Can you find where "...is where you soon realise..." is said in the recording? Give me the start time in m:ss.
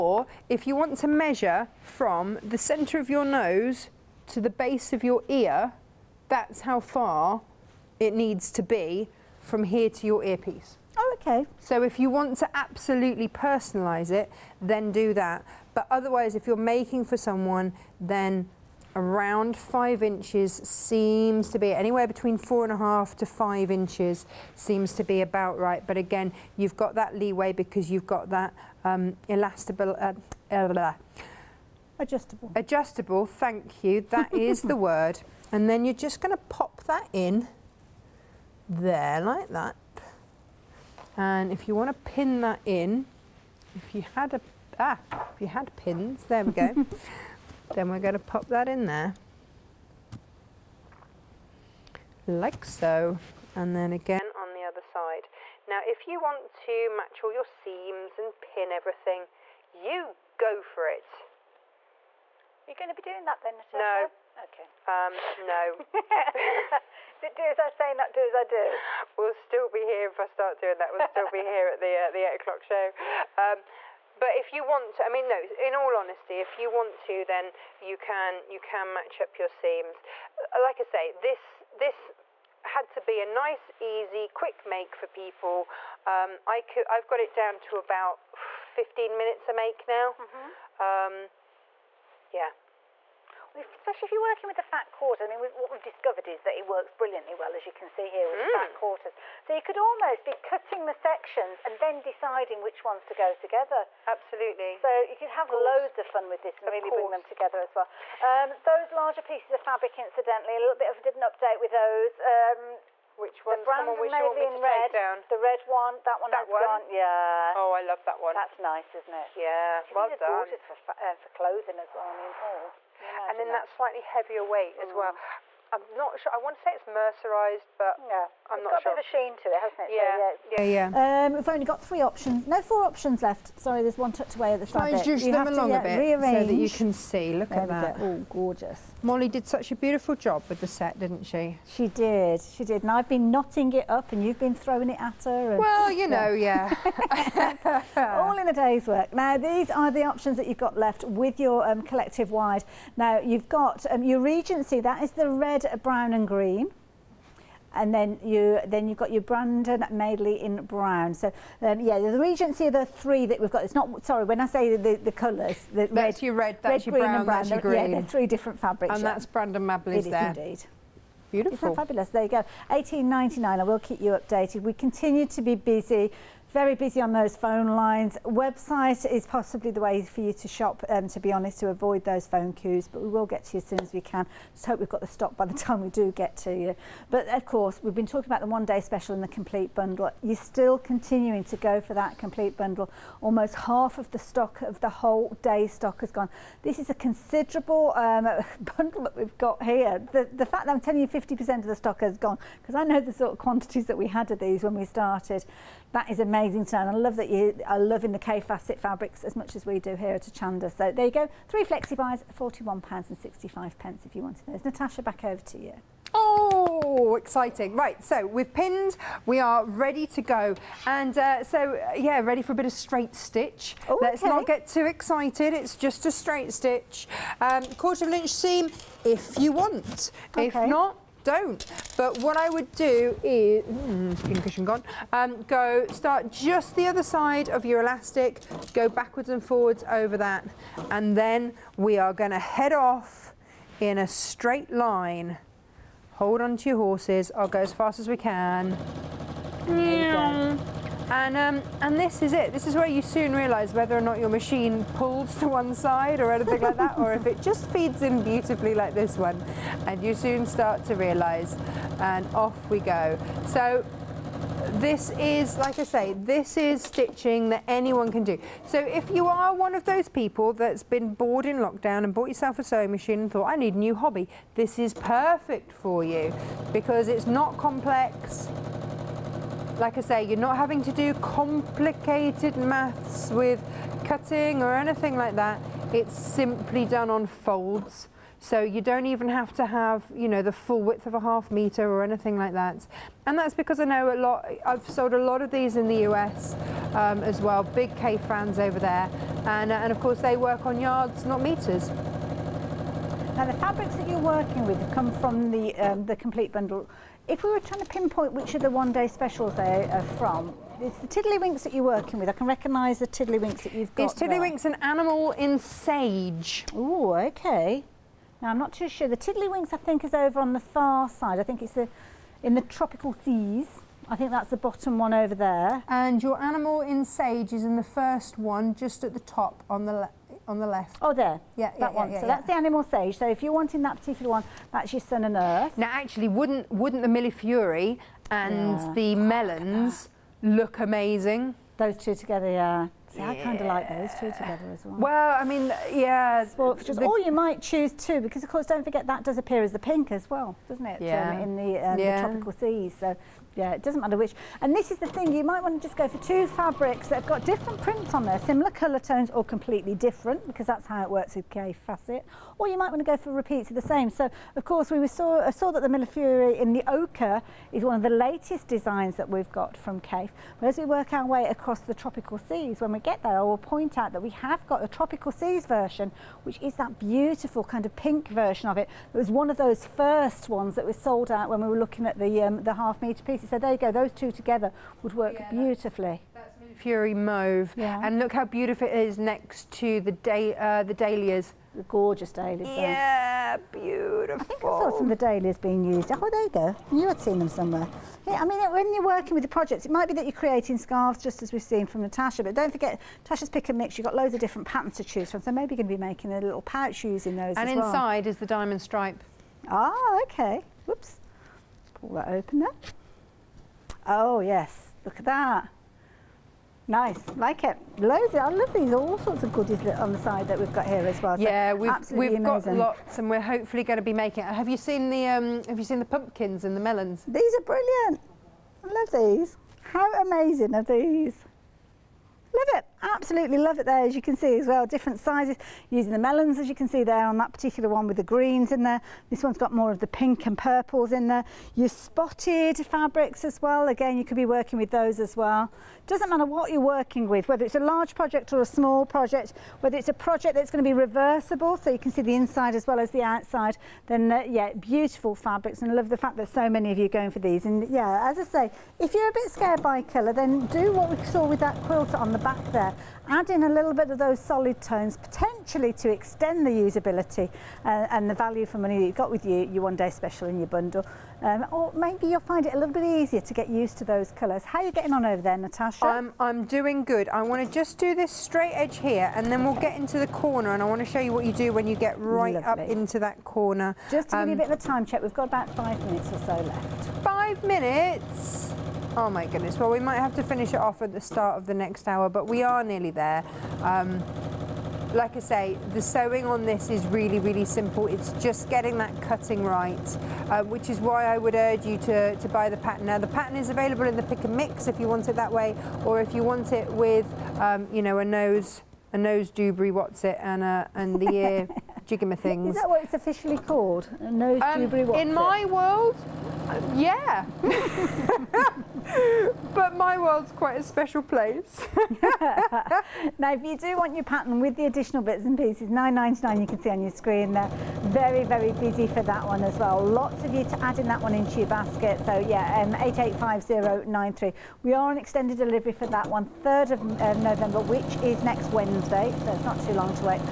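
4:12.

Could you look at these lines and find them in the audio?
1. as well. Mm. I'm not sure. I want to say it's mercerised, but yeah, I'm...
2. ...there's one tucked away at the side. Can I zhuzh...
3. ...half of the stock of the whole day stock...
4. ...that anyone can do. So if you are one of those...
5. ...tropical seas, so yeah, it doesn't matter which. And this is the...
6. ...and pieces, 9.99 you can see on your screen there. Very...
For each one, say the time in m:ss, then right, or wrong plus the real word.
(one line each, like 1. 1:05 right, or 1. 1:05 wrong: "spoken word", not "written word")
1. 2:04 right
2. 2:13 right
3. 3:13 right
4. 4:27 right
5. 5:52 right
6. 8:45 right.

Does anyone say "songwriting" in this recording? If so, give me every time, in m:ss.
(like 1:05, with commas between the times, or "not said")
not said.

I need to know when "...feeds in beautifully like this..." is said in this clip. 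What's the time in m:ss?
4:17.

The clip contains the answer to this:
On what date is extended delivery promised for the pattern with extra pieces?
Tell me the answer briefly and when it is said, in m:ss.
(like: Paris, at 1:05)
3rd of November, at 8:56.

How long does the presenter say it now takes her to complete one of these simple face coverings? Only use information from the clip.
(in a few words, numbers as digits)
15 minutes.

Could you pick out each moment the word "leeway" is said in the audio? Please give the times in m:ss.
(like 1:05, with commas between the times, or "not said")
0:27.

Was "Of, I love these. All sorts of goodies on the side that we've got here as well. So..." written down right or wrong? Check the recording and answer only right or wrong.
right.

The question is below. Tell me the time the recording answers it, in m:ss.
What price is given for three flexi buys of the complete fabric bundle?
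3:32.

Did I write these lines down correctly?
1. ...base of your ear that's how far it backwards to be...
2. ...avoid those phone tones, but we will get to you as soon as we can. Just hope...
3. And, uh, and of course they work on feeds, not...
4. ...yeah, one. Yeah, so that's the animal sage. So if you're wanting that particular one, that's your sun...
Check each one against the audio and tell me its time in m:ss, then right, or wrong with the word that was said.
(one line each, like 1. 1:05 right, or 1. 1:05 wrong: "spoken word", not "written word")
1. 0:04 wrong: "needs", not "backwards"
2. 3:01 wrong: "queues", not "tones"
3. 4:59 wrong: "yards", not "feeds"
4. 5:31 right.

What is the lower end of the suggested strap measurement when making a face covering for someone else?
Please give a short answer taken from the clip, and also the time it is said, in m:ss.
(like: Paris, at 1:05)
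4.5 inches, at 0:22.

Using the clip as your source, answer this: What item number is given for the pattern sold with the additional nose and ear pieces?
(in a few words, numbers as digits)
885093.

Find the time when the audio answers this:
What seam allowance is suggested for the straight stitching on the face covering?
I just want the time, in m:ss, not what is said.
3:47.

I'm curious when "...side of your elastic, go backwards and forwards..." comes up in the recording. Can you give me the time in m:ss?
3:57.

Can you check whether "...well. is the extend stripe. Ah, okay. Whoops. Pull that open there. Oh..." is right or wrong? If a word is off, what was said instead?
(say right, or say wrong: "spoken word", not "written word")
wrong: "diamond", not "extend".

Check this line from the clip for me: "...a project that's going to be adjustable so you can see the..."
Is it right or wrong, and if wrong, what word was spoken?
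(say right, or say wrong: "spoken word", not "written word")
wrong: "reversible", not "adjustable".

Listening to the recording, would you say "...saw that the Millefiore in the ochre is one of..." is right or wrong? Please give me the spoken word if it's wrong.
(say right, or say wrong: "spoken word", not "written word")
right.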